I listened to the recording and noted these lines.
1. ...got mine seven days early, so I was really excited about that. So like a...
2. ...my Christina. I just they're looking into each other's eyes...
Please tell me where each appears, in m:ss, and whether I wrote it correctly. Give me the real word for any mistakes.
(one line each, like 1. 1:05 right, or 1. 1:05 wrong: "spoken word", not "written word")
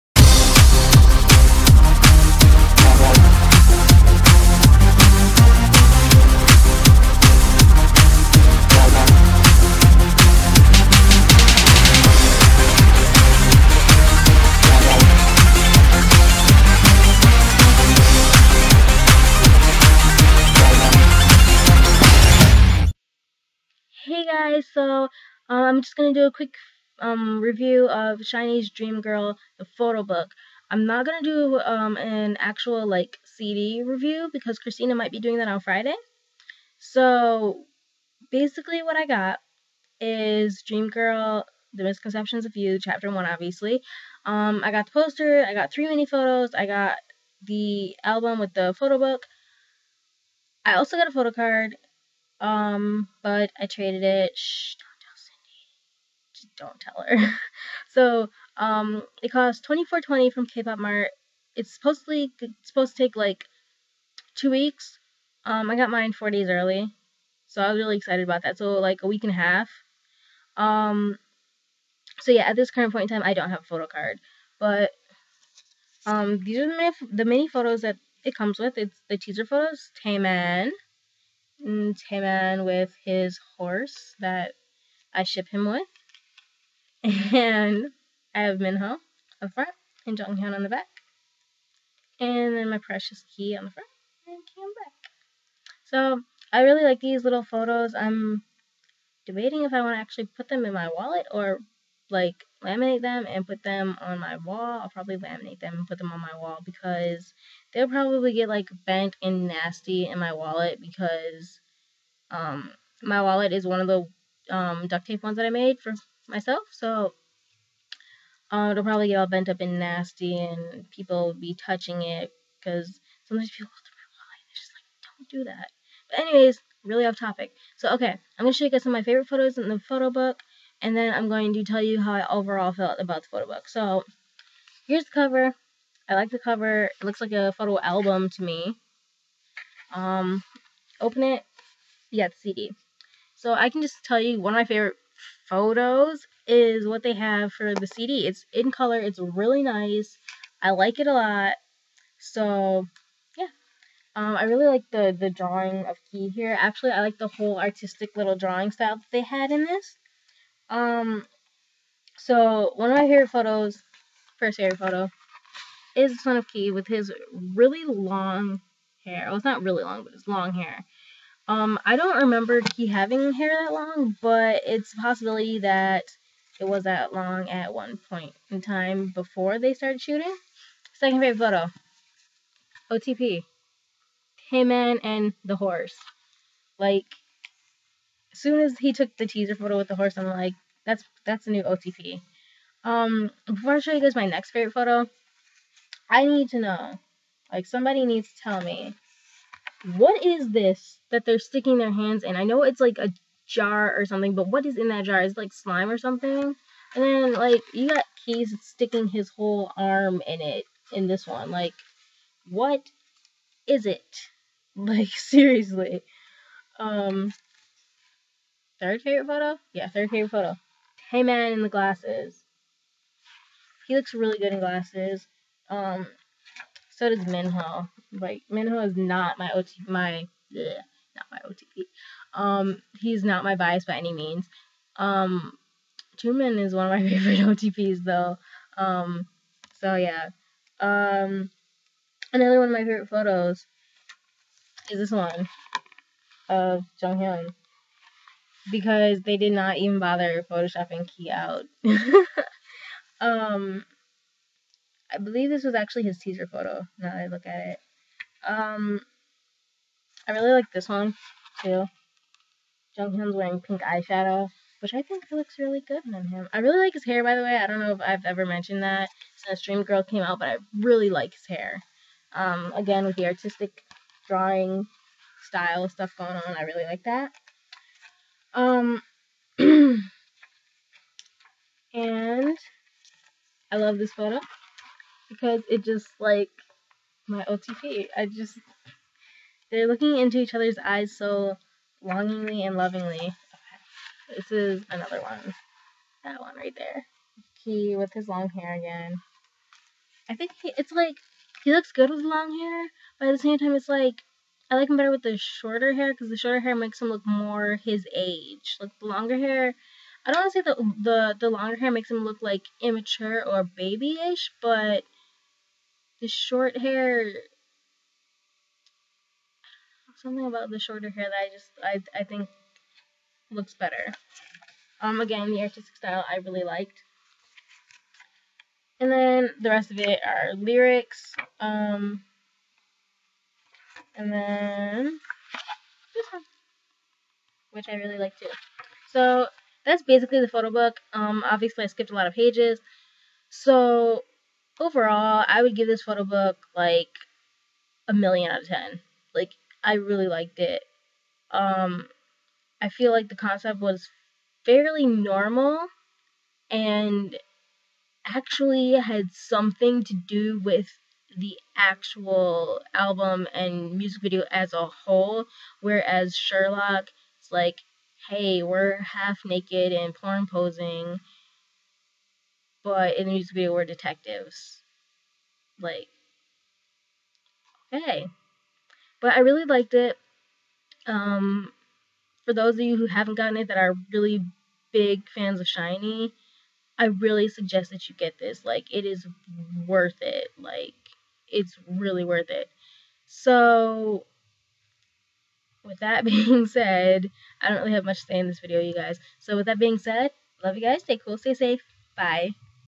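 1. 1:05 wrong: "four", not "seven"
2. 4:47 wrong: "OTP", not "Christina".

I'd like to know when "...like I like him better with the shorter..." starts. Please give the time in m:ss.
5:03.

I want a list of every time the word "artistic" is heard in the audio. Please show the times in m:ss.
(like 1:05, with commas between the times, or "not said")
2:37, 4:33, 5:25.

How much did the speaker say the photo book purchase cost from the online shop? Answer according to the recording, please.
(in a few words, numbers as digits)
24.20.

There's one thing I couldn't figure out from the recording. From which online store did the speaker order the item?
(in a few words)
K-pop Mart.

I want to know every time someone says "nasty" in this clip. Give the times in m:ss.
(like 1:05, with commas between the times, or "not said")
1:49, 1:59.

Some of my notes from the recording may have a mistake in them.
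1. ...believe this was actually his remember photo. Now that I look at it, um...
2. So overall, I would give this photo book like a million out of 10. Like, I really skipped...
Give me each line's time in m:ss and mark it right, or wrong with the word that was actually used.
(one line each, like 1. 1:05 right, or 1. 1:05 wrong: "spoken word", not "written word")
1. 4:15 wrong: "teaser", not "remember"
2. 5:43 wrong: "liked", not "skipped".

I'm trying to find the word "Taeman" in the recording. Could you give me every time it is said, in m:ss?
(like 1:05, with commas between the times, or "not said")
1:20, 3:41, 3:56.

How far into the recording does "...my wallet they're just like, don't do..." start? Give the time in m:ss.
2:03.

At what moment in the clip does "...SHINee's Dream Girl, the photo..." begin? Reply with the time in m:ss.
0:28.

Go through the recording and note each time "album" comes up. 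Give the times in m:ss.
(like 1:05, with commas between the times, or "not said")
0:48, 2:17, 6:02.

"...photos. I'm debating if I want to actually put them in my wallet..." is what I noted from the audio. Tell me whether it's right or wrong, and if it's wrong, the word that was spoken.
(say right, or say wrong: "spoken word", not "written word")
right.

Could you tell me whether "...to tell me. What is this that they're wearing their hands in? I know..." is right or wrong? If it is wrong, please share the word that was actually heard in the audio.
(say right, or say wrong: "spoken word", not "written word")
wrong: "sticking", not "wearing".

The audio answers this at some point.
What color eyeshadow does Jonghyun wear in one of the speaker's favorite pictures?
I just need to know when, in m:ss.
4:23.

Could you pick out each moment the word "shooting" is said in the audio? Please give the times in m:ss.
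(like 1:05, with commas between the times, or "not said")
3:00.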